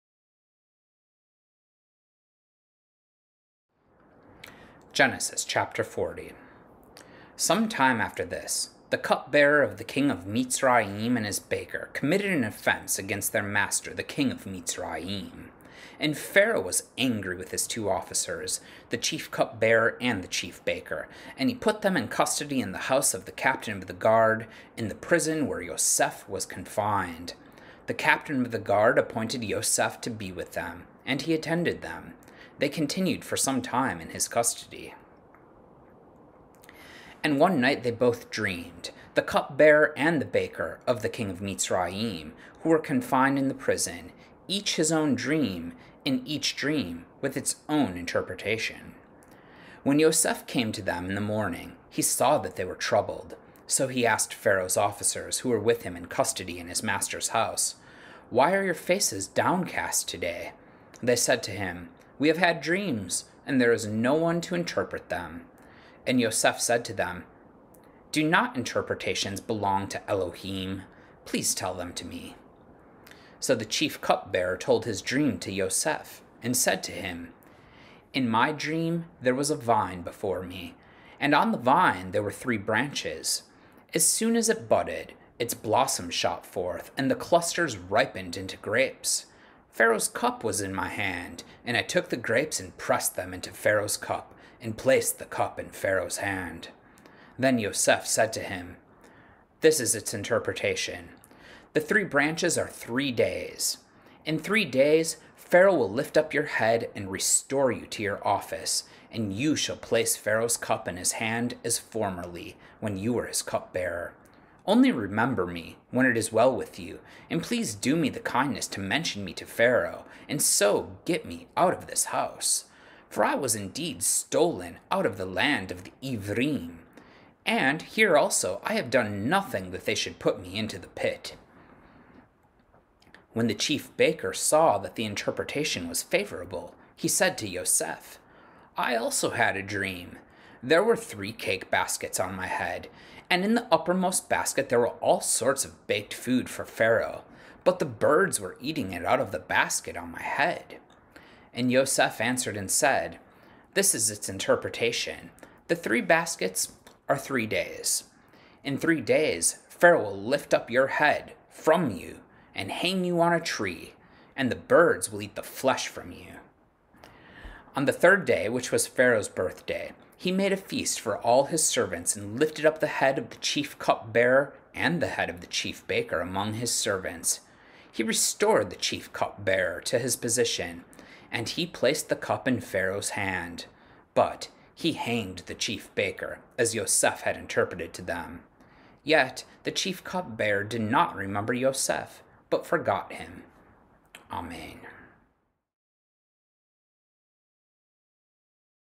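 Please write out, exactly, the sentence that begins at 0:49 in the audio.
When Yoseph came to them in the morning, he saw that they were troubled.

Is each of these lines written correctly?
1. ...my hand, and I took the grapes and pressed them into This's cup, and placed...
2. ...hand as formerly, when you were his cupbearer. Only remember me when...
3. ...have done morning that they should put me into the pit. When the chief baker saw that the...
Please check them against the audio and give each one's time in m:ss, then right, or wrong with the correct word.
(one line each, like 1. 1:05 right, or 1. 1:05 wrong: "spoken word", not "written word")
1. 1:30 wrong: "Pharaoh", not "This"
2. 1:51 right
3. 2:08 wrong: "nothing", not "morning".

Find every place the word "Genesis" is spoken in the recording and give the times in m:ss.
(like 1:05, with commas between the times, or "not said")
0:04.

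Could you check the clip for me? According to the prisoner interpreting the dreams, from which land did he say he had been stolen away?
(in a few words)
The land of the Ivrim.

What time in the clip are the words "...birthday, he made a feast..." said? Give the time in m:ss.
2:49.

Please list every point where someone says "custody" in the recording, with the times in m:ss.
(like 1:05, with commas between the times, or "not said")
0:22, 0:34, 0:56.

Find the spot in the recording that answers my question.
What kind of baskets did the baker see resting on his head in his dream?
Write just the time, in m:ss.
2:21.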